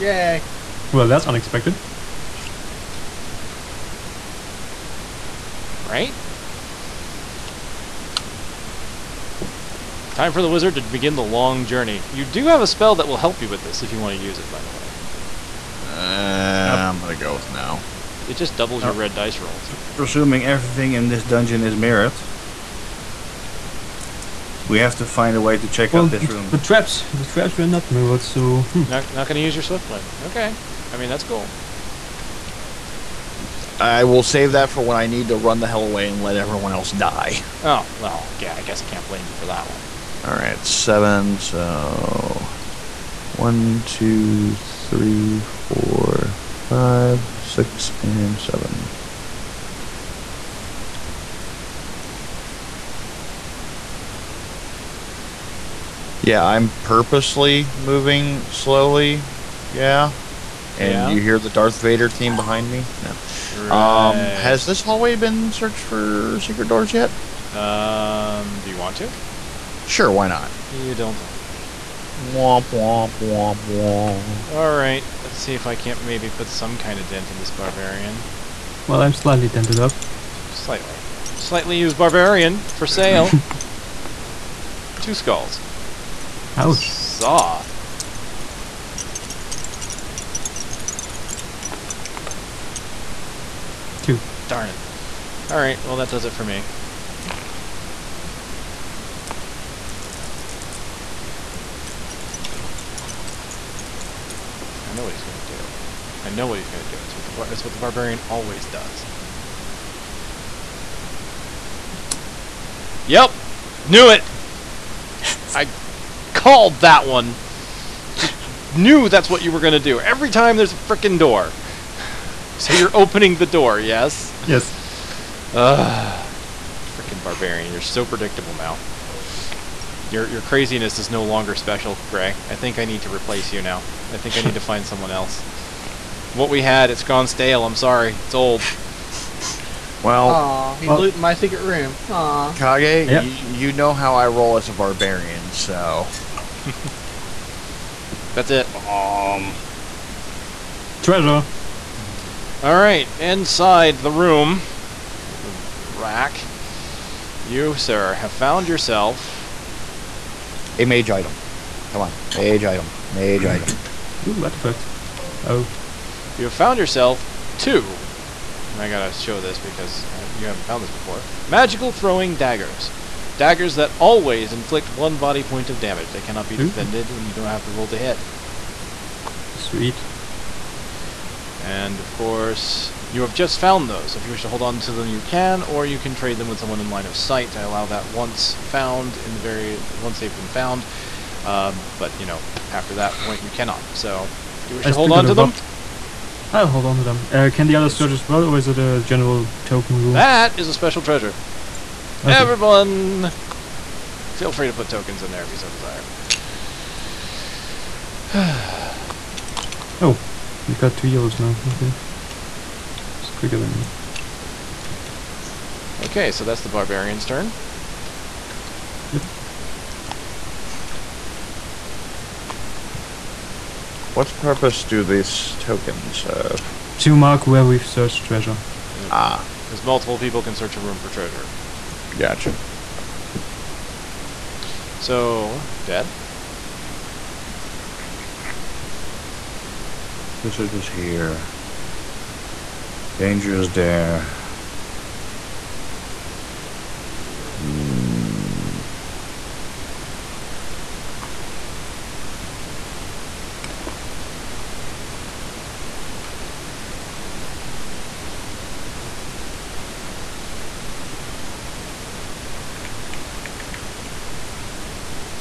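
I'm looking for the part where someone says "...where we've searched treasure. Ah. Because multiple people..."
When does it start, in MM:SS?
03:47.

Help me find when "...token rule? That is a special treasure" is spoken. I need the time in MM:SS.
03:19.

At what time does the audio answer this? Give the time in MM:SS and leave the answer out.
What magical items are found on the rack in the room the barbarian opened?
02:51.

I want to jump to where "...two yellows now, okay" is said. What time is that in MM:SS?
03:30.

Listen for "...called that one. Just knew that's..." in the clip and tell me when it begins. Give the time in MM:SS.
01:56.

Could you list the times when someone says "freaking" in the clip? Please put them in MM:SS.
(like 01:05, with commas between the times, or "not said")
02:00, 02:06.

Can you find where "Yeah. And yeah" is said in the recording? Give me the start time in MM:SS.
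00:59.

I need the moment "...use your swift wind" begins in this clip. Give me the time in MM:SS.
00:29.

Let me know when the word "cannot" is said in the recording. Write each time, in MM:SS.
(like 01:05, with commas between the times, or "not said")
02:56, 03:13.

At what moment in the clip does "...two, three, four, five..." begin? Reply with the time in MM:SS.
00:43.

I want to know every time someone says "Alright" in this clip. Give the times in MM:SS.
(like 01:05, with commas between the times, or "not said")
01:14, 01:35.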